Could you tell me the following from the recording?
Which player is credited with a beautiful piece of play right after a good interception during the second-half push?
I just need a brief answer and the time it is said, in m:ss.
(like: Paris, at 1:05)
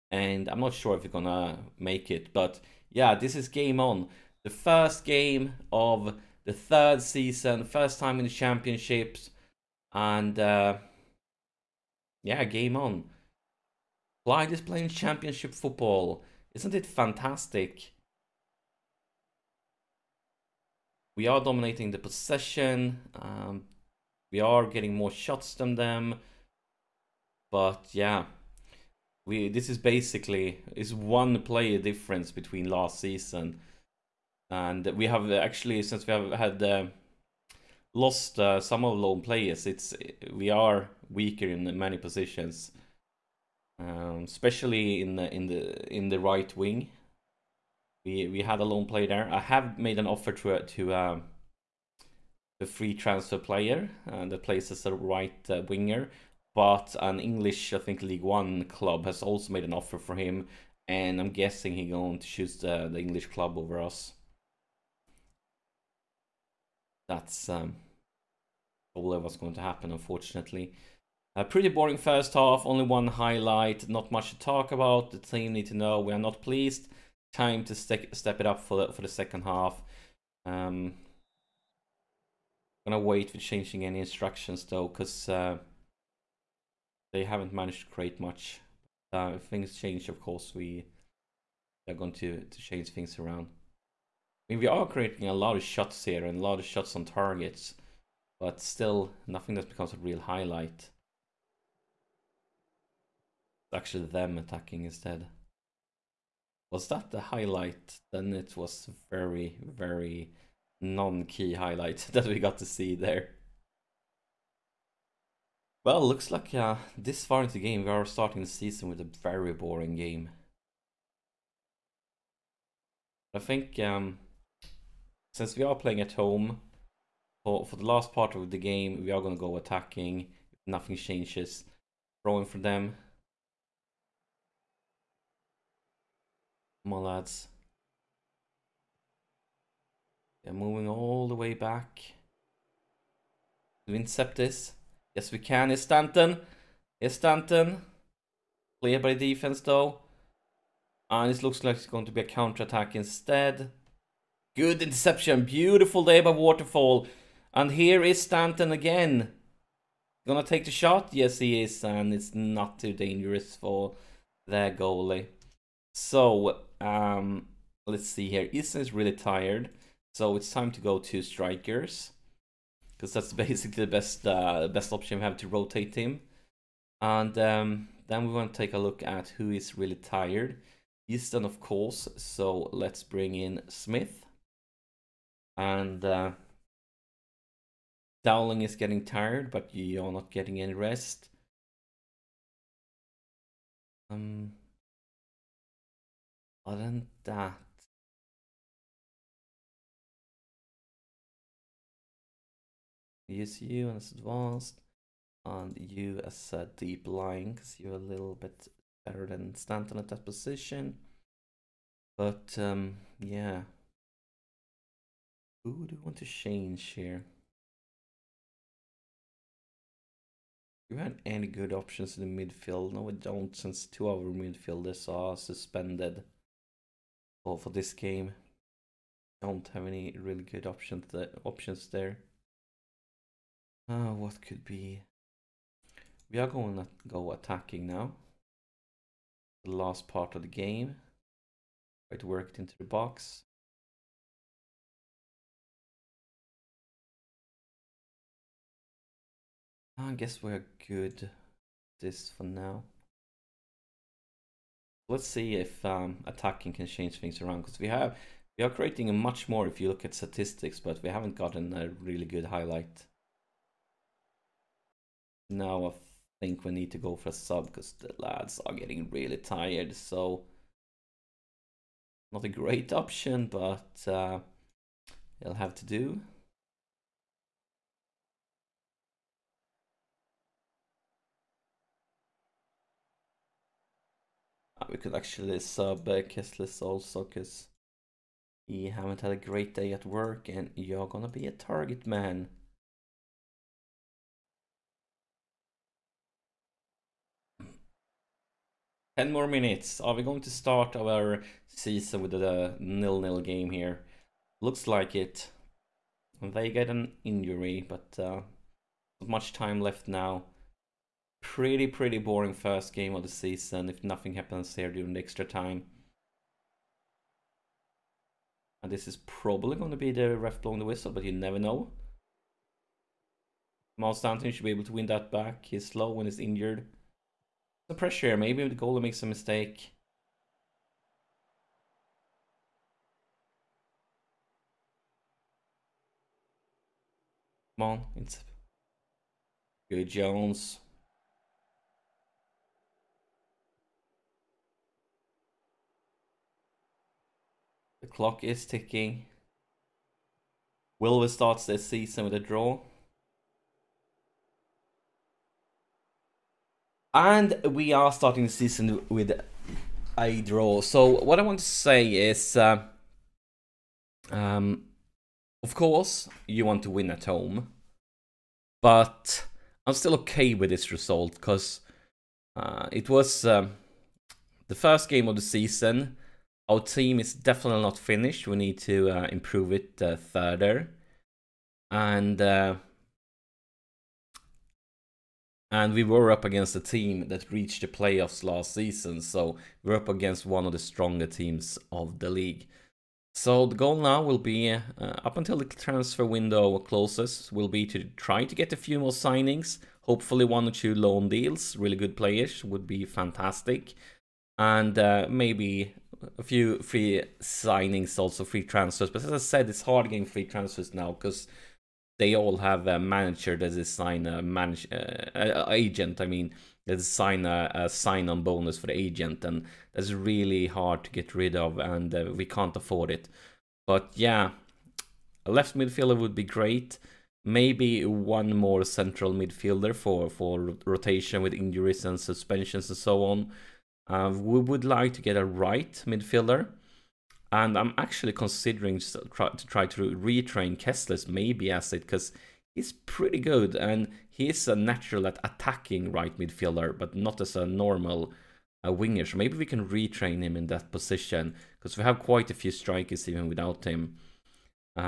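Waterfall, at 2:36.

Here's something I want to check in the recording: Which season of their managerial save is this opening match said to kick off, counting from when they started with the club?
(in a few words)
Third.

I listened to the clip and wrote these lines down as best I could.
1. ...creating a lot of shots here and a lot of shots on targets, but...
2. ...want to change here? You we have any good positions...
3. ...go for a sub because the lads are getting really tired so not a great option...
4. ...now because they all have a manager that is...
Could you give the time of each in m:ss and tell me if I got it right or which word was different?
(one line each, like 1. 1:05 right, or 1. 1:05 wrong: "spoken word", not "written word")
1. 1:34 right
2. 3:36 wrong: "options", not "positions"
3. 4:26 right
4. 6:50 right.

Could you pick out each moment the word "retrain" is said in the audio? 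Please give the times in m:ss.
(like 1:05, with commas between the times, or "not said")
7:20, 7:29.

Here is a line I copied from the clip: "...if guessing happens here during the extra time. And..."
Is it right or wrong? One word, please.
wrong.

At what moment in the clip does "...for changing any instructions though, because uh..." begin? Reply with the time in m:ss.
1:23.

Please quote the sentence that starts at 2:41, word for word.
And it's not too dangerous for their goalie.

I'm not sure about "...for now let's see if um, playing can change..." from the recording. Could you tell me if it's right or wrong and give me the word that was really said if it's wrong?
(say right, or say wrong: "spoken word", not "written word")
wrong: "attacking", not "playing".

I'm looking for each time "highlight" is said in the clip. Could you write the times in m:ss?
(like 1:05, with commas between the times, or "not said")
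1:13, 1:40, 1:47, 1:51, 4:22.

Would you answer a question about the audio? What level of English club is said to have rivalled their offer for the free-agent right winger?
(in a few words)
League One.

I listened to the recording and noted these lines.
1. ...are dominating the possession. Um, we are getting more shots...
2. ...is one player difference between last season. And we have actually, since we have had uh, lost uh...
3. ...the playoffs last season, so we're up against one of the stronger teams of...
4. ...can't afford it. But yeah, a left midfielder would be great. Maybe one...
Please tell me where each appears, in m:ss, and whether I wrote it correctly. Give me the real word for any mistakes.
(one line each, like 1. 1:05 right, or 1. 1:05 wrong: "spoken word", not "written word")
1. 0:21 right
2. 0:30 right
3. 6:27 right
4. 7:02 right.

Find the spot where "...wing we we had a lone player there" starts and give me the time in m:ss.
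0:46.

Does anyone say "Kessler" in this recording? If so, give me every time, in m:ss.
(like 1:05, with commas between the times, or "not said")
4:46, 7:20.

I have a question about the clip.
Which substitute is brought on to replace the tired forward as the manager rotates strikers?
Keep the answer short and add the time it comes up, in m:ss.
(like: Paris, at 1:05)
Smith, at 3:03.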